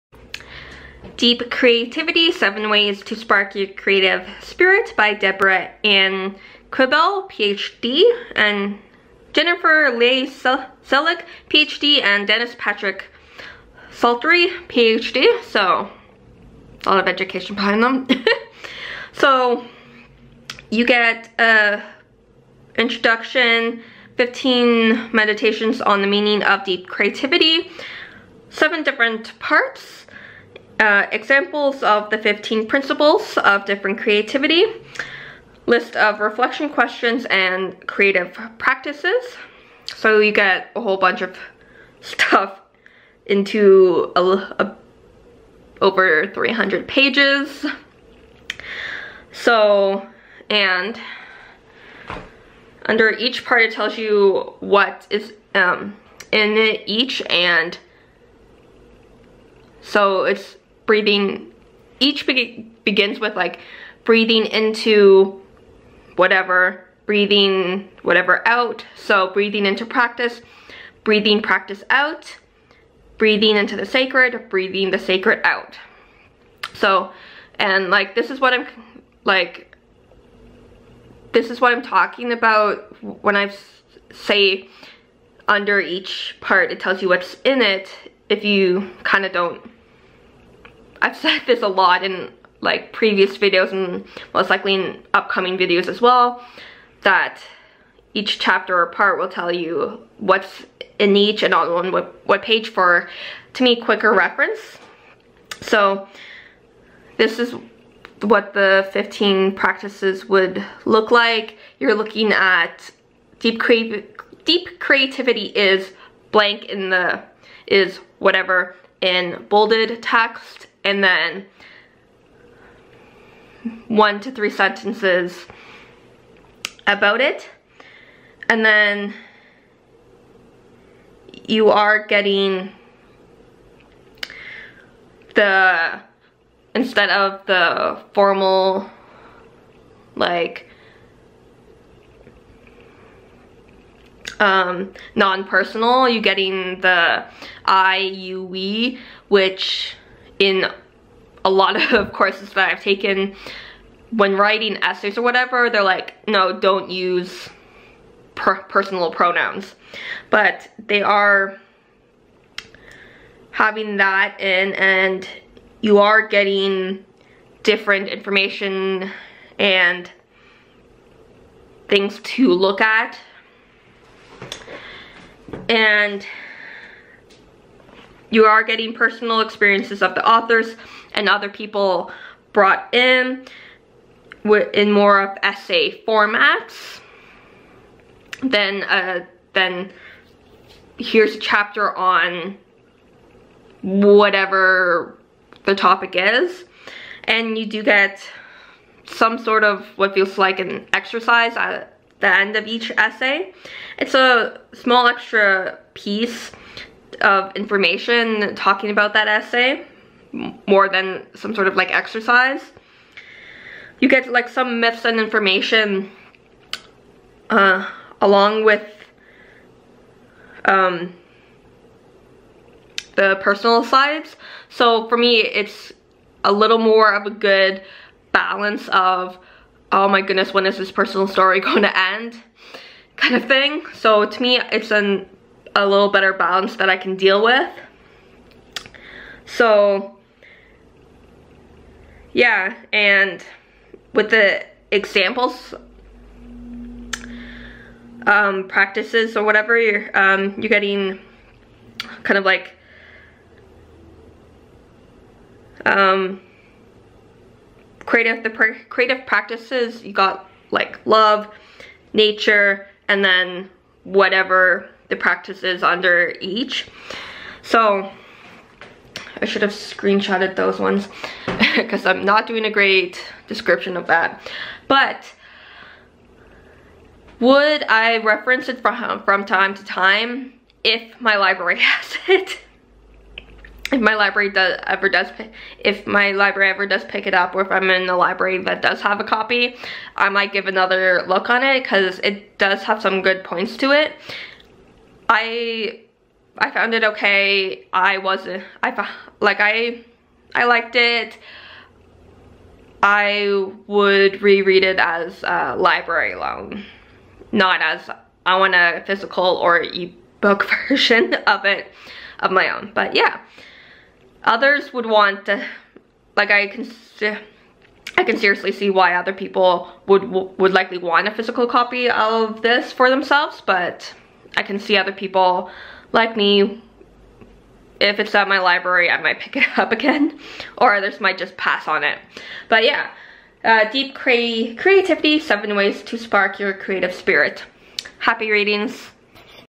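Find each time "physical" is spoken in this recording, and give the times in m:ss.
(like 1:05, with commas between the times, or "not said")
5:09, 5:21.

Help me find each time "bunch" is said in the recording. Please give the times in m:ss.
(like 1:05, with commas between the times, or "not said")
0:40.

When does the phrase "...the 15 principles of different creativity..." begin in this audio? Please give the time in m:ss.
0:32.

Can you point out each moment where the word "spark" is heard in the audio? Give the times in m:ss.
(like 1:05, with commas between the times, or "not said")
0:03, 5:36.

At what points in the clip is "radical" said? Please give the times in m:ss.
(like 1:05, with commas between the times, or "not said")
not said.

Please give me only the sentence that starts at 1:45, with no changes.
So this is what the 15 practices would look like.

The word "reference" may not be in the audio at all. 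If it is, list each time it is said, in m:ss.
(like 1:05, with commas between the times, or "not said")
1:44, 4:38.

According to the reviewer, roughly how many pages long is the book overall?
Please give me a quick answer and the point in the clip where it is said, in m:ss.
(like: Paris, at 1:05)
over 300, at 0:45.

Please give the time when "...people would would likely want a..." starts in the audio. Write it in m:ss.
5:19.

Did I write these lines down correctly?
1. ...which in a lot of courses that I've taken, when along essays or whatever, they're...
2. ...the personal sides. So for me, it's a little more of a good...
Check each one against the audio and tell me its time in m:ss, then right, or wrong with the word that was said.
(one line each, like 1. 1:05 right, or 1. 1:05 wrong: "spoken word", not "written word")
1. 2:29 wrong: "writing", not "along"
2. 3:43 right.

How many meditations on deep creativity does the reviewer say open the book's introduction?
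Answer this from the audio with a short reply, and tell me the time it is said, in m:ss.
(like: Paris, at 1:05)
15, at 0:24.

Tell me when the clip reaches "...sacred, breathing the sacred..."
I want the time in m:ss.
1:13.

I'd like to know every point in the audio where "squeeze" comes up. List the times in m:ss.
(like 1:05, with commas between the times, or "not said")
not said.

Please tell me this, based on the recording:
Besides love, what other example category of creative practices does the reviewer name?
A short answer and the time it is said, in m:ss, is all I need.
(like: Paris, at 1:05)
nature, at 4:22.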